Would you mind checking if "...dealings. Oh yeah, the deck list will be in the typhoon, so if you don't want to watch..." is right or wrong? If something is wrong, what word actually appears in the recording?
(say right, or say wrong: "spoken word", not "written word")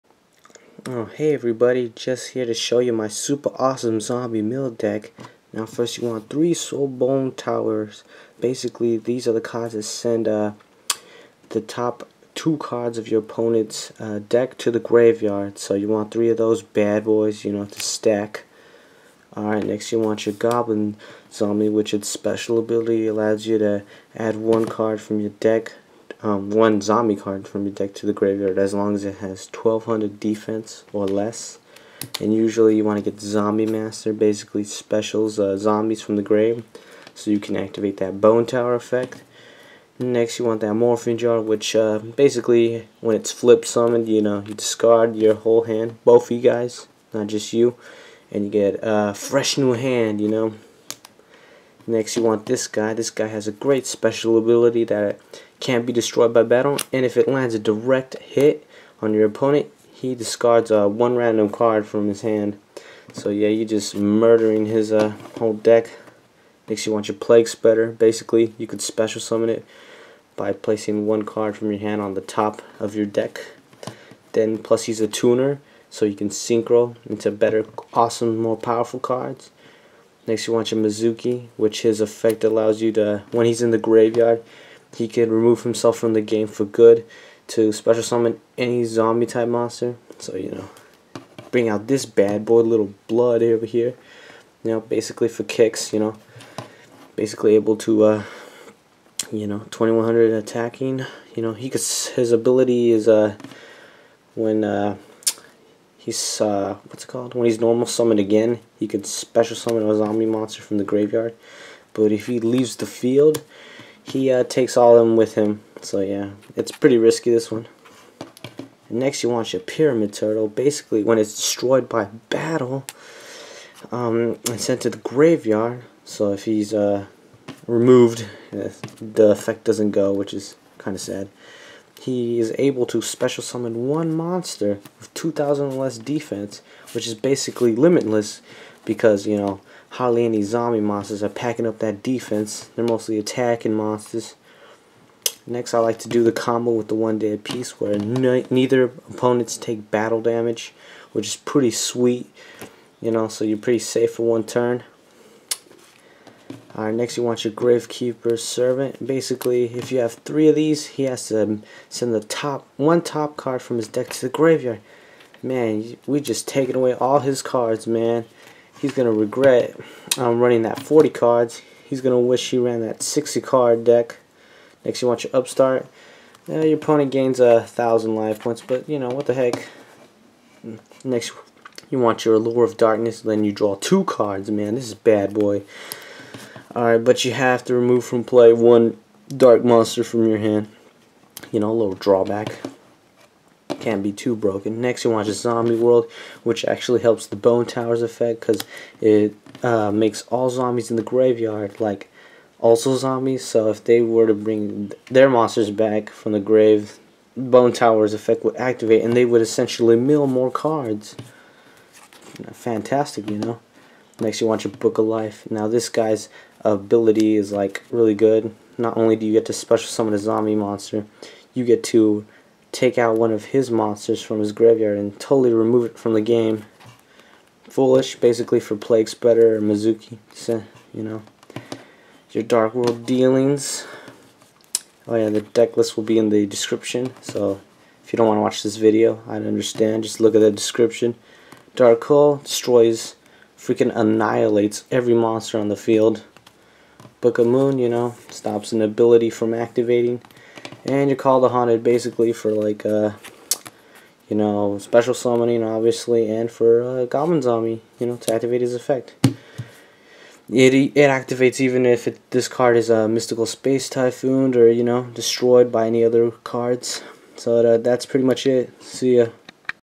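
wrong: "description", not "typhoon".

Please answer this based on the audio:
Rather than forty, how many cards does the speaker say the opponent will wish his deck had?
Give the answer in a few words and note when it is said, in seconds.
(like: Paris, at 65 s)
60, at 173 s.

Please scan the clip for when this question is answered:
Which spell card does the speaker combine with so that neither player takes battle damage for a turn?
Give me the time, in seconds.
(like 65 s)
146 s.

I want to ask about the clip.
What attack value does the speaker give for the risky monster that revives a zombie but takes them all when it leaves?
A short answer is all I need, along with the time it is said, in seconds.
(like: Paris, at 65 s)
2100, at 99 s.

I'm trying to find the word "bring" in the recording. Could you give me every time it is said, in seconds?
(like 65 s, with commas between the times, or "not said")
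91 s, 204 s.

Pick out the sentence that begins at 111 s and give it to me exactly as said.
But if he leaves the field, he uh, takes all of them with him.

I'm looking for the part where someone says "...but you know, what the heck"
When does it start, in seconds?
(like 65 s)
178 s.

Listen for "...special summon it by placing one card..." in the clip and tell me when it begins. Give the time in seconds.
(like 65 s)
68 s.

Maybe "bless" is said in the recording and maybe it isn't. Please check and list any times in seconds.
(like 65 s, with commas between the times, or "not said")
not said.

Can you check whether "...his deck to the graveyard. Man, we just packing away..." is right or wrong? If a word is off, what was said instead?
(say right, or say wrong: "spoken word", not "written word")
wrong: "taking", not "packing".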